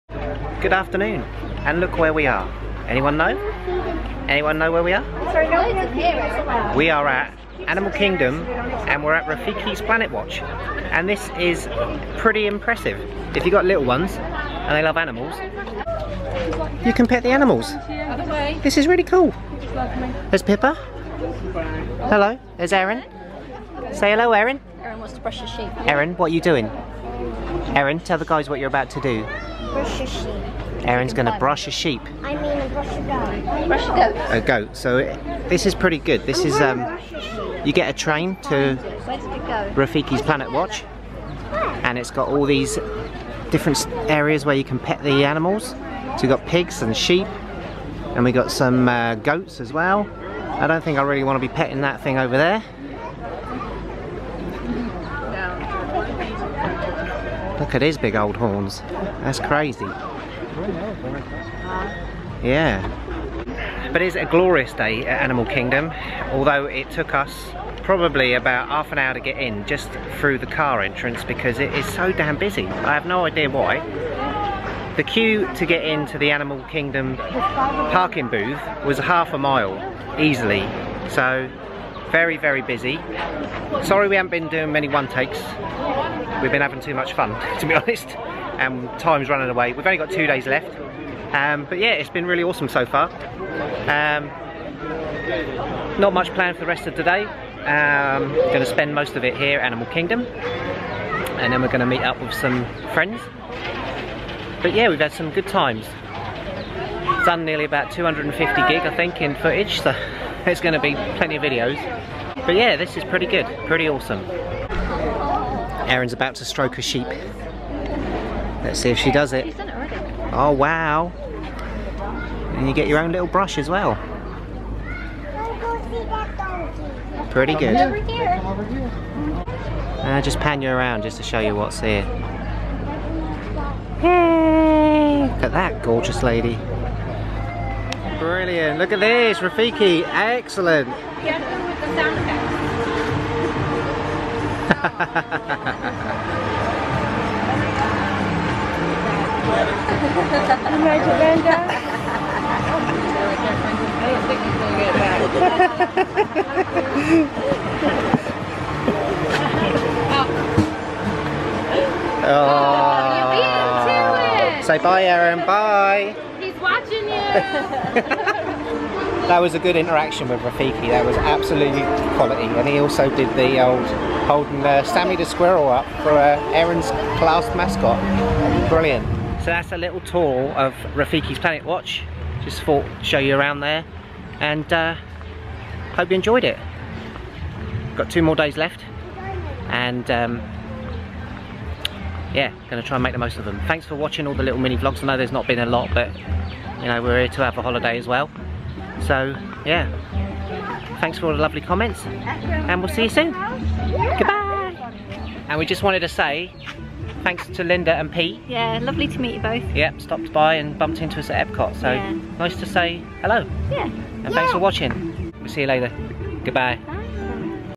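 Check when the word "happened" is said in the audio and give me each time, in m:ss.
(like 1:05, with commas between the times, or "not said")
not said.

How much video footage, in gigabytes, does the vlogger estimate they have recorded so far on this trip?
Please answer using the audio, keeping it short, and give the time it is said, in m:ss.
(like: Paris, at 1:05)
250, at 1:47.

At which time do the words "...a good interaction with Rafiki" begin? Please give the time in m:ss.
2:49.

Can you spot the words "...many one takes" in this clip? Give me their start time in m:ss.
1:24.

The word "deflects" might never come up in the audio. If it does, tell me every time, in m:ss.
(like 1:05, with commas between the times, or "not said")
not said.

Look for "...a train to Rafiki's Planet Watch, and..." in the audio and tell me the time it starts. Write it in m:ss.
0:37.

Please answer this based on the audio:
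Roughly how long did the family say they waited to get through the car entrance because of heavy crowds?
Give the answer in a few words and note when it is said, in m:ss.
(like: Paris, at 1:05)
half an hour, at 1:08.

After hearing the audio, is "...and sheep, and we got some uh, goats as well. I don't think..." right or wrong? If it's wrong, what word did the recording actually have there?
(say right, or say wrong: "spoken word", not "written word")
right.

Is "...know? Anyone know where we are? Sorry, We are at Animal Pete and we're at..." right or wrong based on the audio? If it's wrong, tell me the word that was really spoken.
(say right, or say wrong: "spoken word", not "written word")
wrong: "Kingdom", not "Pete".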